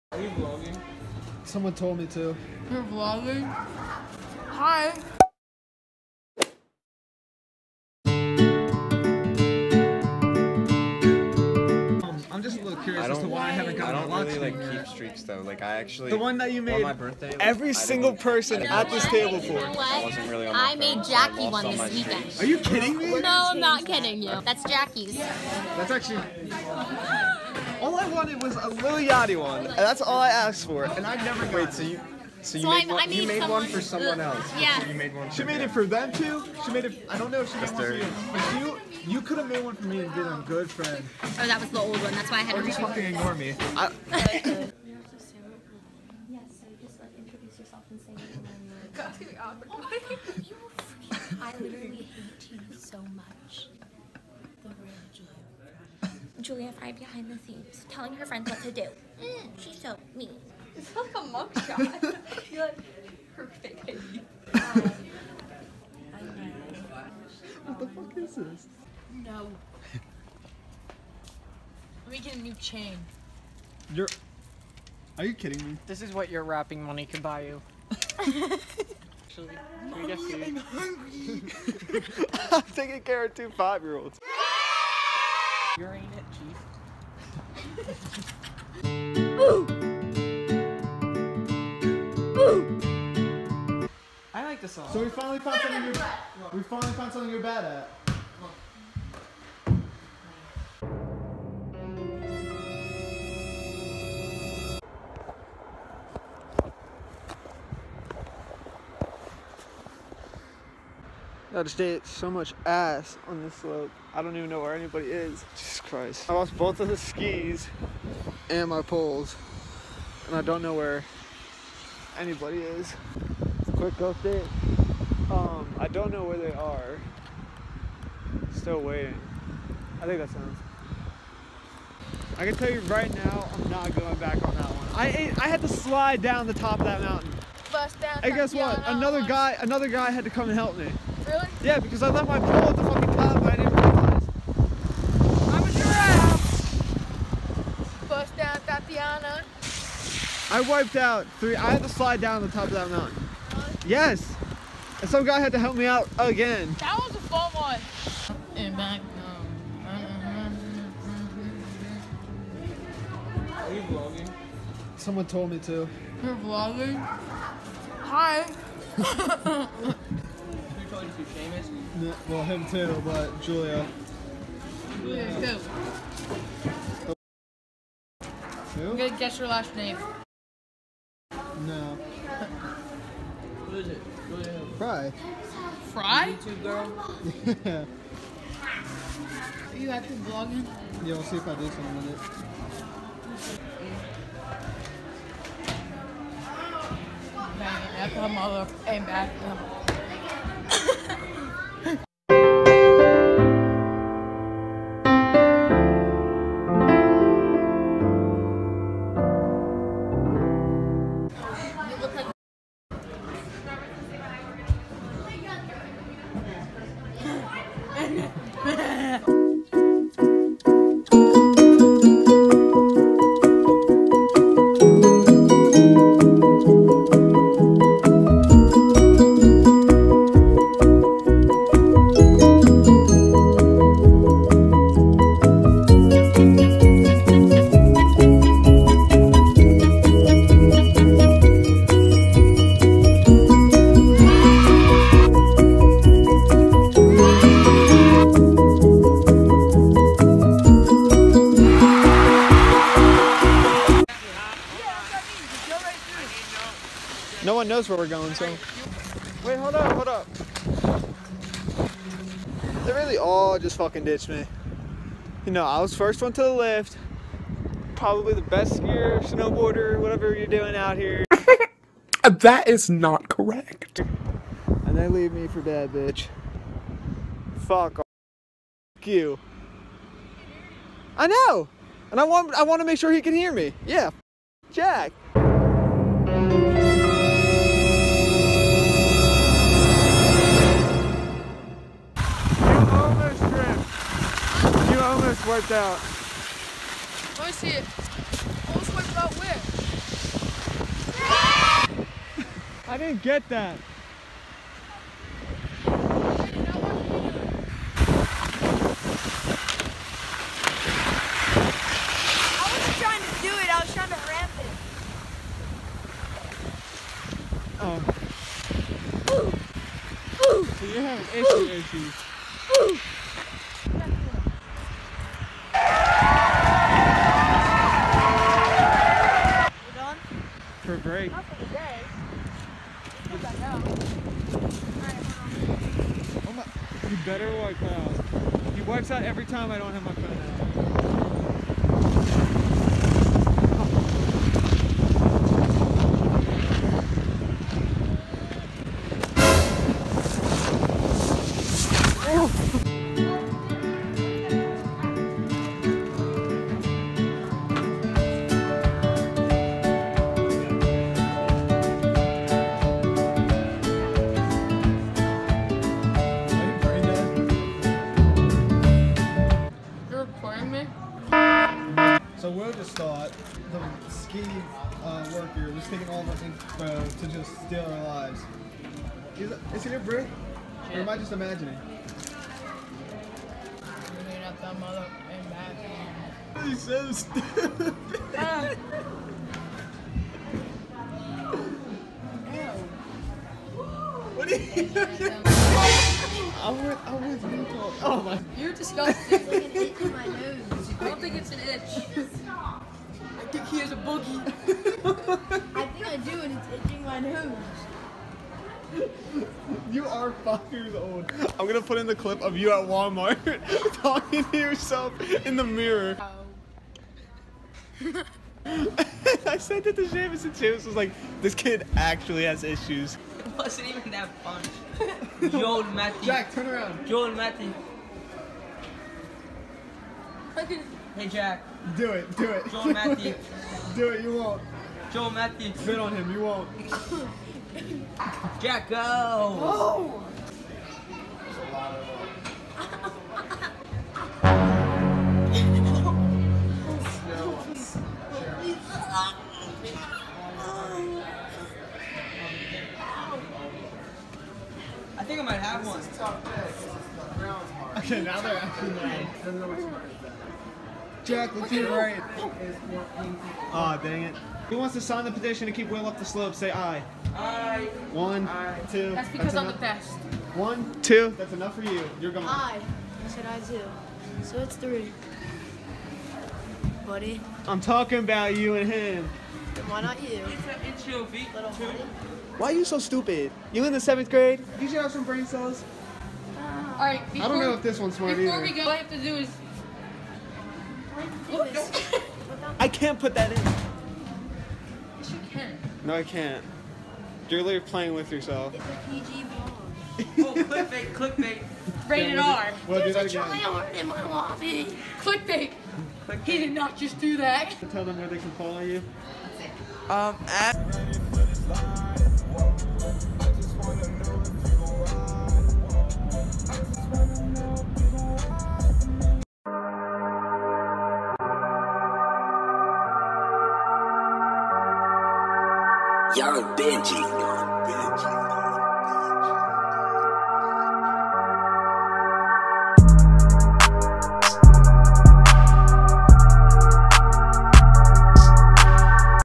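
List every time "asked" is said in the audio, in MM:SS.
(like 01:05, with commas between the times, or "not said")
00:30.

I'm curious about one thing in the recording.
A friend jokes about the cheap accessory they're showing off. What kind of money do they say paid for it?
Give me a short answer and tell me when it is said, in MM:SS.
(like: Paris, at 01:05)
Rapping money, at 01:16.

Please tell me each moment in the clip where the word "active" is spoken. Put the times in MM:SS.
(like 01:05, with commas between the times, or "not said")
03:09.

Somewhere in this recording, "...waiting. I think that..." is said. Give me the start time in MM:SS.
02:08.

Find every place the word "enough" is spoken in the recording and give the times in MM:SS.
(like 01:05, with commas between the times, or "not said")
07:51.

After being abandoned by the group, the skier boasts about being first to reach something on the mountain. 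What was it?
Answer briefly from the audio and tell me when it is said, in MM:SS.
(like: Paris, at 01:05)
The lift, at 04:25.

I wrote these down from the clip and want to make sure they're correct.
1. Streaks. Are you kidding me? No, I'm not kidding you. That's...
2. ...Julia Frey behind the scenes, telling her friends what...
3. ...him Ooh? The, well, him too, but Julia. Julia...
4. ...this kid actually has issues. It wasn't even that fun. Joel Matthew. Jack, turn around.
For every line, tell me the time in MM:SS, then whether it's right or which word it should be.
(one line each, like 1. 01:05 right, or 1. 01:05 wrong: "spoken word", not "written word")
1. 00:22 right
2. 00:56 right
3. 02:51 wrong: "Seamus", not "Ooh"
4. 07:01 right.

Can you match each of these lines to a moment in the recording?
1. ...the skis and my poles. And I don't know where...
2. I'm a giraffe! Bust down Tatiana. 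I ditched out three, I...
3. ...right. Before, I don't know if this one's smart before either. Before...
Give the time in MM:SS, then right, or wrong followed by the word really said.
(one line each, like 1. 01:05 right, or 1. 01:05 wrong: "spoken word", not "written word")
1. 01:56 right
2. 02:25 wrong: "wiped", not "ditched"
3. 08:07 right.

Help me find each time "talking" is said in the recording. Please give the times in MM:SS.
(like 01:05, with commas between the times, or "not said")
06:54, 07:57.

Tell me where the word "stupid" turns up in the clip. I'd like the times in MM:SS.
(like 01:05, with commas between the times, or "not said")
06:27, 08:02.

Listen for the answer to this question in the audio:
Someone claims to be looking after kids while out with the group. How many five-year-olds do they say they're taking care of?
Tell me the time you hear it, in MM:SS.
01:23.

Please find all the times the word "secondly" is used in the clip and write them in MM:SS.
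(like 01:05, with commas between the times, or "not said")
not said.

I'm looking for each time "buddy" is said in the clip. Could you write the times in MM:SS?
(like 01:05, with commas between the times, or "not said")
07:57, 08:01.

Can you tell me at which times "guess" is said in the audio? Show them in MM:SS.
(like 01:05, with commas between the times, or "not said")
02:18, 02:59.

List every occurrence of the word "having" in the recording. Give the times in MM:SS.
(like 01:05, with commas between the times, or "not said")
05:21.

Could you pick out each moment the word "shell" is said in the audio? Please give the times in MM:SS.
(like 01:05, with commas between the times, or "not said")
not said.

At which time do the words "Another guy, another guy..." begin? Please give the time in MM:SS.
02:18.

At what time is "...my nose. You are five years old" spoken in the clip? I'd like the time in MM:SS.
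06:47.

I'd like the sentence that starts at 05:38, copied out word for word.
He wipes out every time I don't have my phone out.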